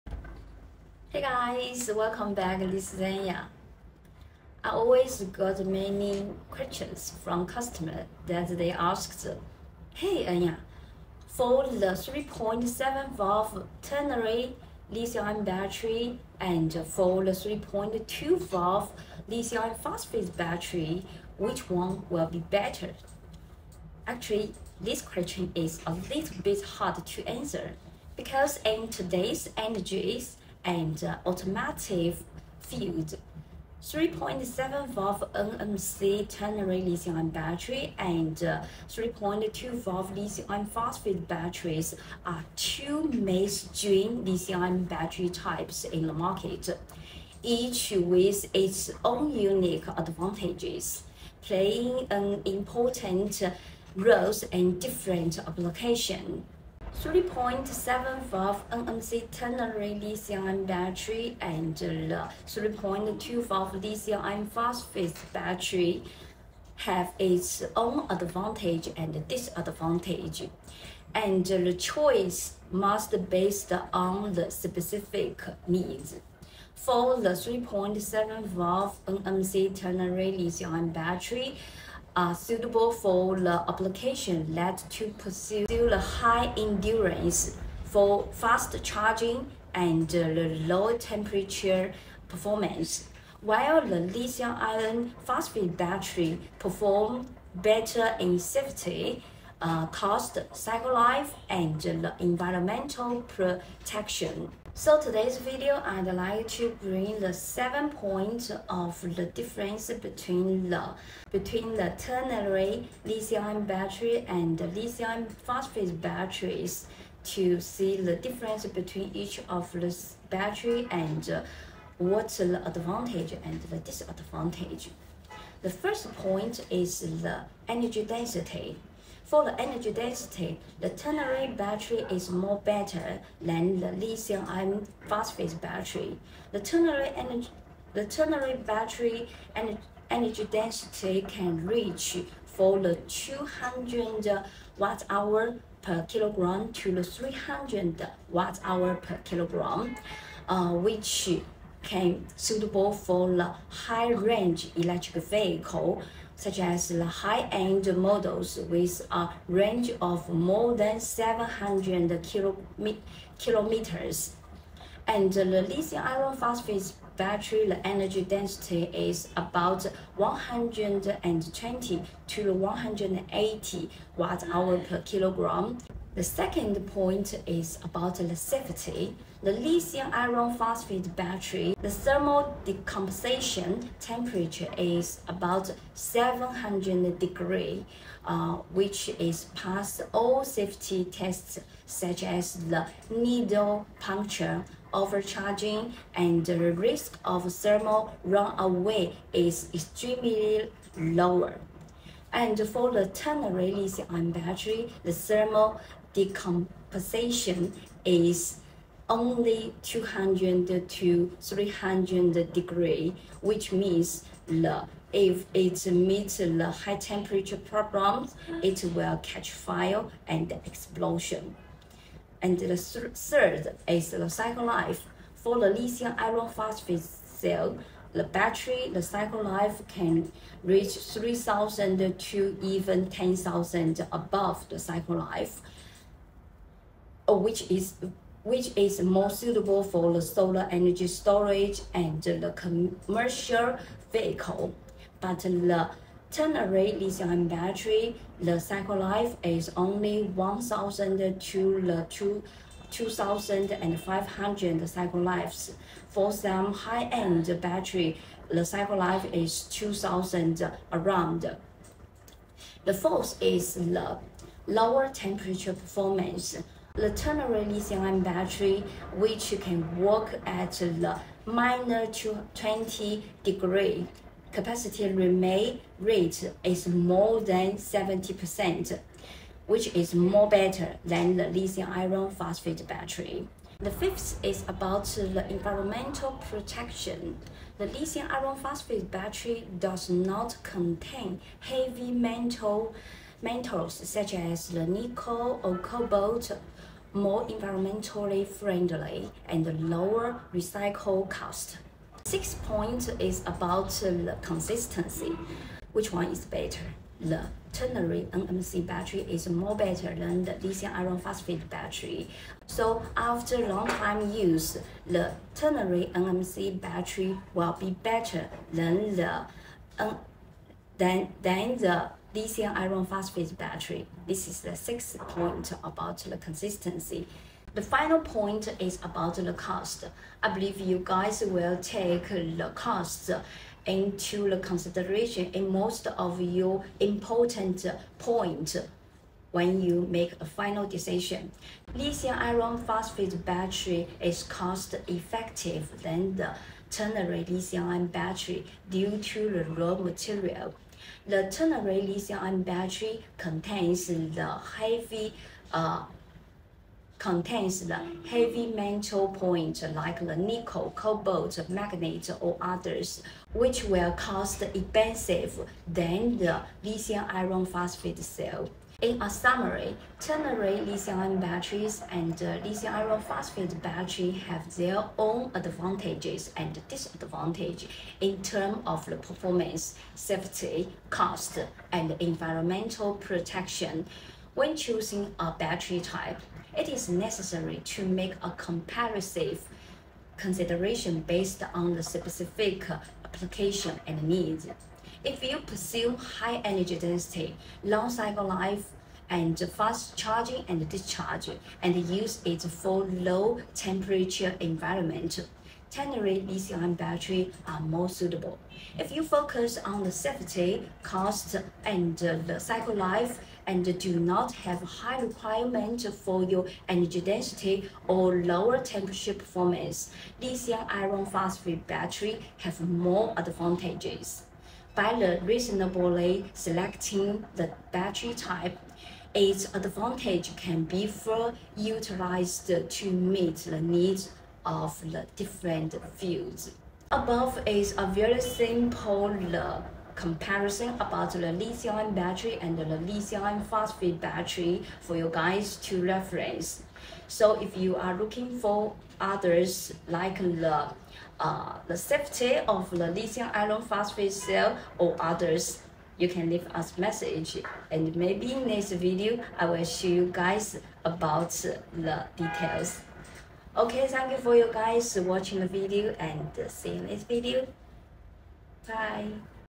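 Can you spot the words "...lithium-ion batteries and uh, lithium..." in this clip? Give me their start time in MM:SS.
06:10.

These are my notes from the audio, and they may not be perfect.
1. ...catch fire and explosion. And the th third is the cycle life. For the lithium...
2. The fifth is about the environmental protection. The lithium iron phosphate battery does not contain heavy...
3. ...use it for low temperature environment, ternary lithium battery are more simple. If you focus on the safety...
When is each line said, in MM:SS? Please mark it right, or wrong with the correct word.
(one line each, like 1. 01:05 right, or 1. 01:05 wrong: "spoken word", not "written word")
1. 03:39 right
2. 04:43 right
3. 06:42 wrong: "suitable", not "simple".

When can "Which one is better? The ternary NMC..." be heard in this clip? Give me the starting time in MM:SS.
05:05.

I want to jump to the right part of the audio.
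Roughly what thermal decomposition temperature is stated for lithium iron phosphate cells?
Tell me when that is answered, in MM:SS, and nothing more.
03:05.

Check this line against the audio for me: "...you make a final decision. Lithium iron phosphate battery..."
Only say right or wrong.
right.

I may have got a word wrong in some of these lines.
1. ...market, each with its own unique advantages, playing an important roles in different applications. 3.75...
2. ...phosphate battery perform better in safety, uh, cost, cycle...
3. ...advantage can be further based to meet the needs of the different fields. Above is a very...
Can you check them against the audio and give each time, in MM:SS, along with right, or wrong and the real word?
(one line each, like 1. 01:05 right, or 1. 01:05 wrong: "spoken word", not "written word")
1. 00:46 right
2. 01:35 right
3. 07:09 wrong: "utilized", not "based".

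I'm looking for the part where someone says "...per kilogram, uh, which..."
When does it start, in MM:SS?
02:28.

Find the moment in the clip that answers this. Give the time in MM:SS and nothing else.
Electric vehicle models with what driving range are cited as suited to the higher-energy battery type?
02:40.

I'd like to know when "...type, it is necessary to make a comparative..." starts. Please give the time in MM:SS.
06:25.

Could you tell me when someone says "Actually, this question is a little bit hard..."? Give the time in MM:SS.
00:24.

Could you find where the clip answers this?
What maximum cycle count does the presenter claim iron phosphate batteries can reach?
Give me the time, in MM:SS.
03:53.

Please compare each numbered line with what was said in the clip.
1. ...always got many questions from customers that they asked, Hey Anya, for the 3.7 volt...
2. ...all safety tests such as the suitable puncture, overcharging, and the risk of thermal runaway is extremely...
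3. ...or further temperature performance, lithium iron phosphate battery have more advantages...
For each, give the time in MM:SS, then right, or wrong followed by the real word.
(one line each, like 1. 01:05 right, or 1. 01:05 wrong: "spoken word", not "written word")
1. 00:04 right
2. 03:10 wrong: "needle", not "suitable"
3. 06:58 wrong: "lower", not "further".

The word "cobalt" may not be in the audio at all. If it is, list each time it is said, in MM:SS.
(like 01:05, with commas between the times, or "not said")
04:55, 06:00.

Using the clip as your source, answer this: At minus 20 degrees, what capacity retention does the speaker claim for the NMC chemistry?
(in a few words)
more than 70%.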